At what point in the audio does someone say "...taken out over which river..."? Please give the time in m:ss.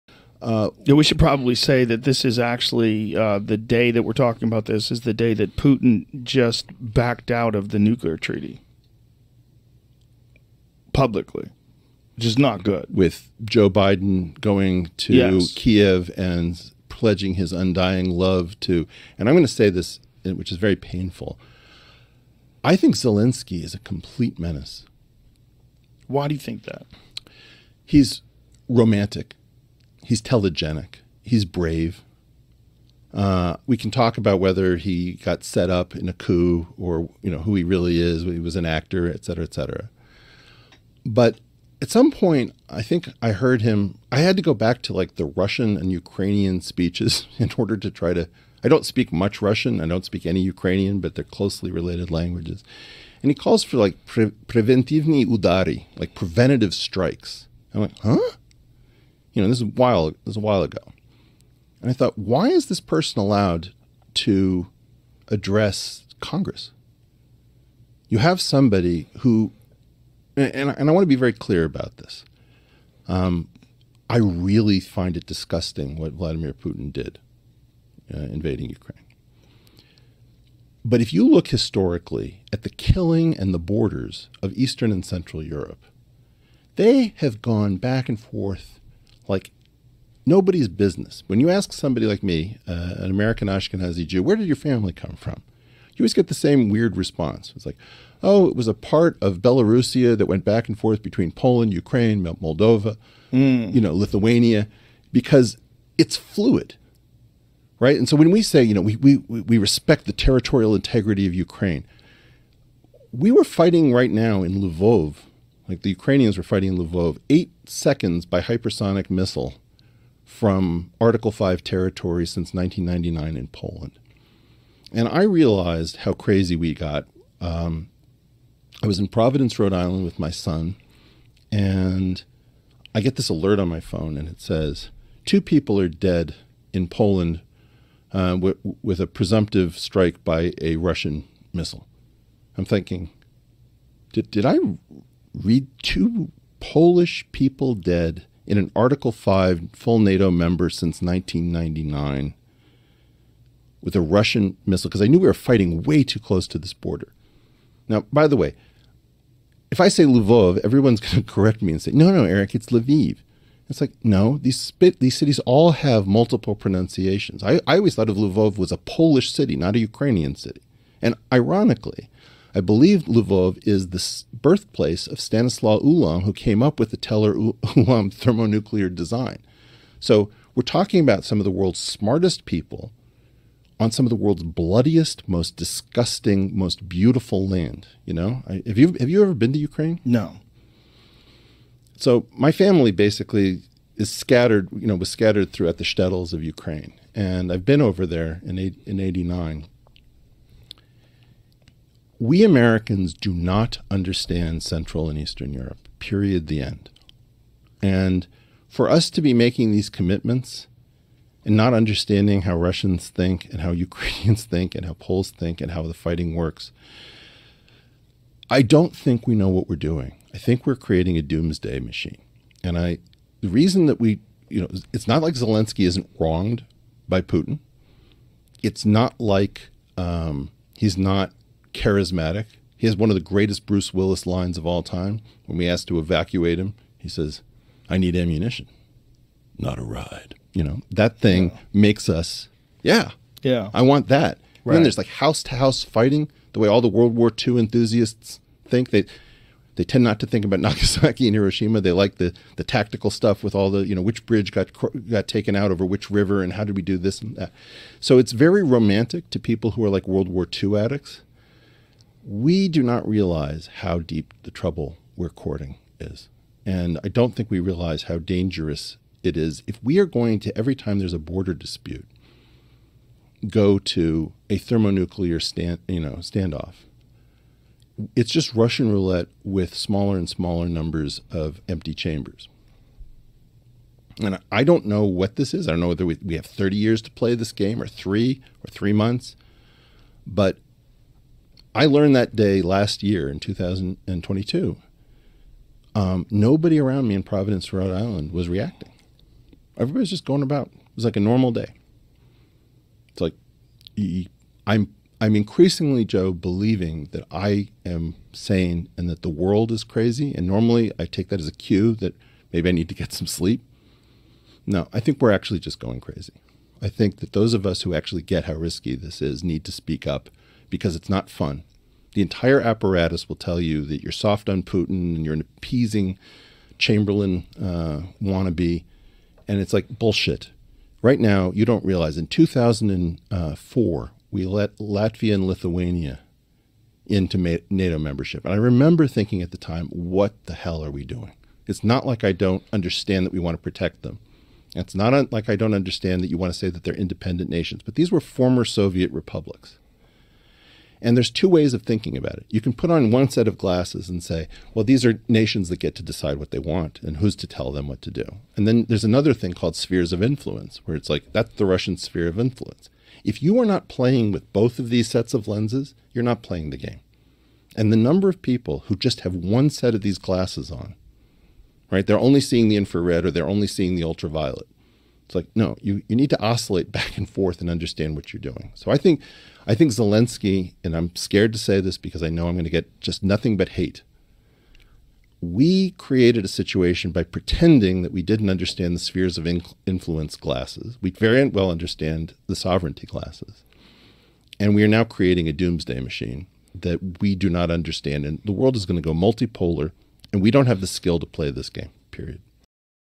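4:15.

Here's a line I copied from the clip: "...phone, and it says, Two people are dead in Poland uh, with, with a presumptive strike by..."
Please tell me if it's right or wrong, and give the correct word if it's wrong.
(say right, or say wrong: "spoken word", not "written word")
right.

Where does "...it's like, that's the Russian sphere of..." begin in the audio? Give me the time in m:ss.
6:00.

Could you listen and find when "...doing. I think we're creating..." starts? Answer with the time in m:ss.
3:39.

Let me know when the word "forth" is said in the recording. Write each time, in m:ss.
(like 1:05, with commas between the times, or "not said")
1:28, 1:40, 6:17.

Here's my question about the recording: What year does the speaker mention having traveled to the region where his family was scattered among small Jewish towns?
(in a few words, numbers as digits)
1989.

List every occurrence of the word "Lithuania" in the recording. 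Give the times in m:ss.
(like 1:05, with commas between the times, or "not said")
1:43, 5:35.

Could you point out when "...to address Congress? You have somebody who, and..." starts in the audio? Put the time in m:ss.
1:04.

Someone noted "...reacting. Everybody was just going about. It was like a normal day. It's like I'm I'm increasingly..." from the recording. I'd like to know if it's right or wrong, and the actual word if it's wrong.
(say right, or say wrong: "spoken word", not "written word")
right.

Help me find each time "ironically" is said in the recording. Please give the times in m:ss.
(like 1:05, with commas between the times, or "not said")
2:51.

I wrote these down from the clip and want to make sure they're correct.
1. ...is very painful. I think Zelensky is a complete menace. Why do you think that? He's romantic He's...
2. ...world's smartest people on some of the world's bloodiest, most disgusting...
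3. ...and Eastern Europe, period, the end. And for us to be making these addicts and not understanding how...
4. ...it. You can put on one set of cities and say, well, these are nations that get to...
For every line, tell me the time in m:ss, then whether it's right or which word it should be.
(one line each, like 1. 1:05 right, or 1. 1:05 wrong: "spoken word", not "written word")
1. 0:20 right
2. 3:01 right
3. 3:25 wrong: "commitments", not "addicts"
4. 5:52 wrong: "glasses", not "cities".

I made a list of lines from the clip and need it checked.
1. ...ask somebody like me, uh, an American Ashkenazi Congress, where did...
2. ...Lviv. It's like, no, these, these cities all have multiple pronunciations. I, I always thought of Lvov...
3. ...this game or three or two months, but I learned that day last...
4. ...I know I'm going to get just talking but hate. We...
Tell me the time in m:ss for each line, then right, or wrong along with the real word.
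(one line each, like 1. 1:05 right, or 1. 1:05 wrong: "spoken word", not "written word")
1. 1:31 wrong: "Jew", not "Congress"
2. 2:42 right
3. 4:47 wrong: "three", not "two"
4. 6:22 wrong: "nothing", not "talking".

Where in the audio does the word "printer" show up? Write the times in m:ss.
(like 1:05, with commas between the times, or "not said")
not said.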